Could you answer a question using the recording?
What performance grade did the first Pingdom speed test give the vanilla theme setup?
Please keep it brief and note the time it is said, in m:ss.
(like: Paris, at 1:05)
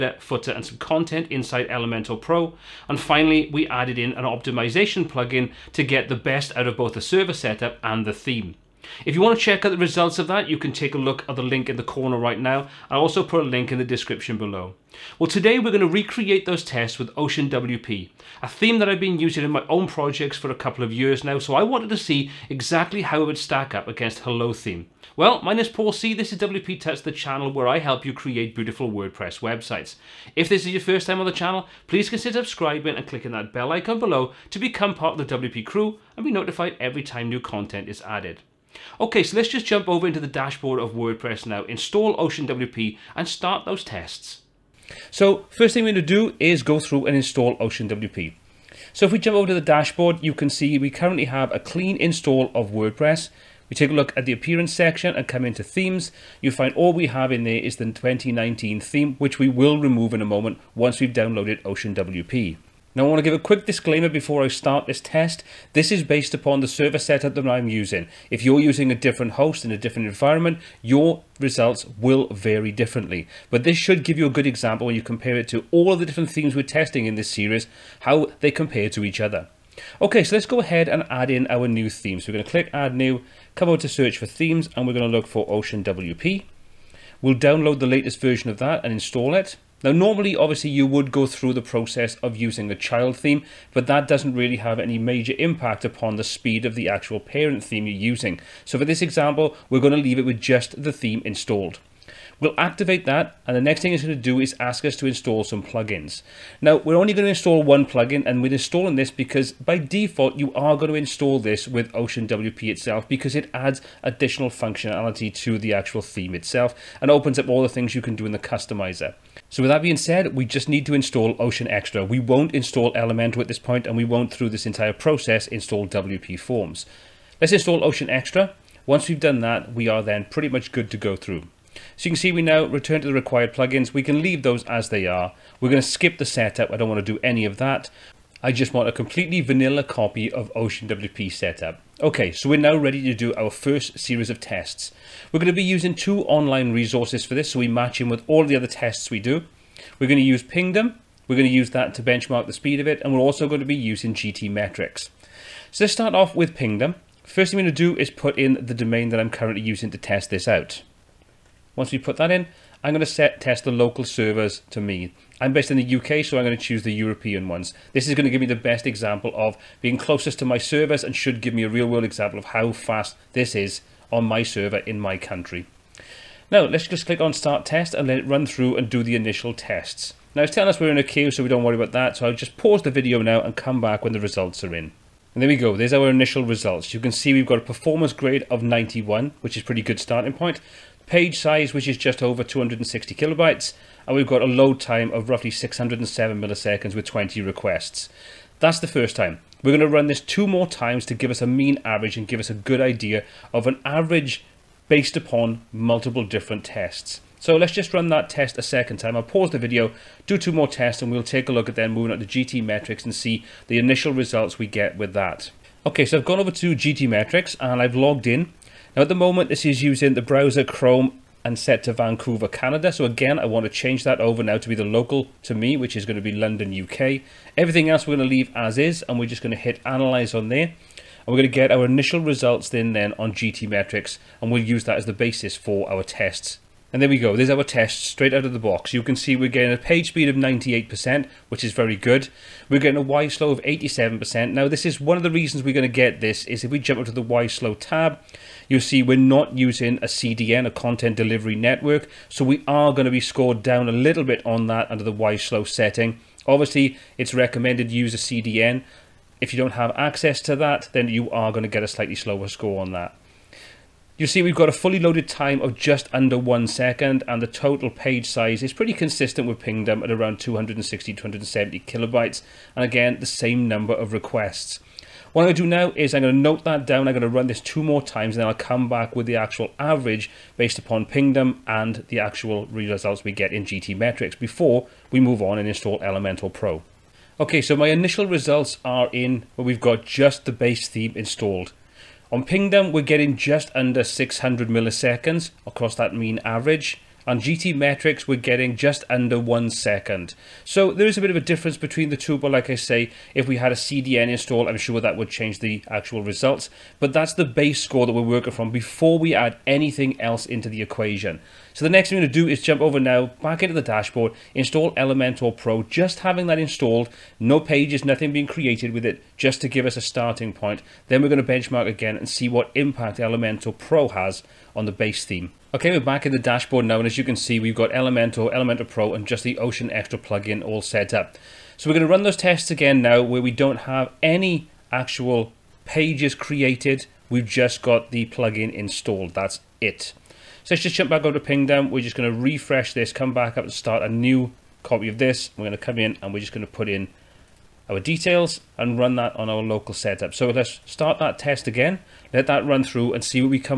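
91, at 3:08.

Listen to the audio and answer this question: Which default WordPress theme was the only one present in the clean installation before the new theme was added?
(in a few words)
2019.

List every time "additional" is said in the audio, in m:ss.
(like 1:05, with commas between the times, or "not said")
1:54.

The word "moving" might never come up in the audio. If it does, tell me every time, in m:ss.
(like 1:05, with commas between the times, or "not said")
3:31.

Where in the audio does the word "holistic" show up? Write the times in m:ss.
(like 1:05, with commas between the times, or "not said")
not said.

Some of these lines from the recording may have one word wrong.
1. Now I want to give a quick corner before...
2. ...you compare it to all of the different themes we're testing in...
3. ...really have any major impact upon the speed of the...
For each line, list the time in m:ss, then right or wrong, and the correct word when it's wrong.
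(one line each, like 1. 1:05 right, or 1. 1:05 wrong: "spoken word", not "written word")
1. 1:02 wrong: "disclaimer", not "corner"
2. 1:14 right
3. 1:34 right.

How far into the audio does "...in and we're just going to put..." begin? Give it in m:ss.
5:45.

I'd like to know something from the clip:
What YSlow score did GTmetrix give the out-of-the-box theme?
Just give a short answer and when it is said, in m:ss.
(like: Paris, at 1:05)
87%, at 4:03.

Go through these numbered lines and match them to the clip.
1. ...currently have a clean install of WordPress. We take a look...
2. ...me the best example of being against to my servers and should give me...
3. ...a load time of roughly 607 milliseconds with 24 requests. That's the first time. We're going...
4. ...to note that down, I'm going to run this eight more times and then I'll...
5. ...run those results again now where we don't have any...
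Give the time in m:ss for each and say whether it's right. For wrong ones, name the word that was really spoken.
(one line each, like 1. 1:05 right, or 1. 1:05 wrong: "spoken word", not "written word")
1. 0:50 right
2. 2:48 wrong: "closest", not "against"
3. 3:14 wrong: "20", not "24"
4. 4:36 wrong: "two", not "eight"
5. 5:32 wrong: "tests", not "results".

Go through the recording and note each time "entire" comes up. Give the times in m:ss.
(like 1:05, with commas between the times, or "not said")
2:04.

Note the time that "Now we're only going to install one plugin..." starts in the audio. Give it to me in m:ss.
1:46.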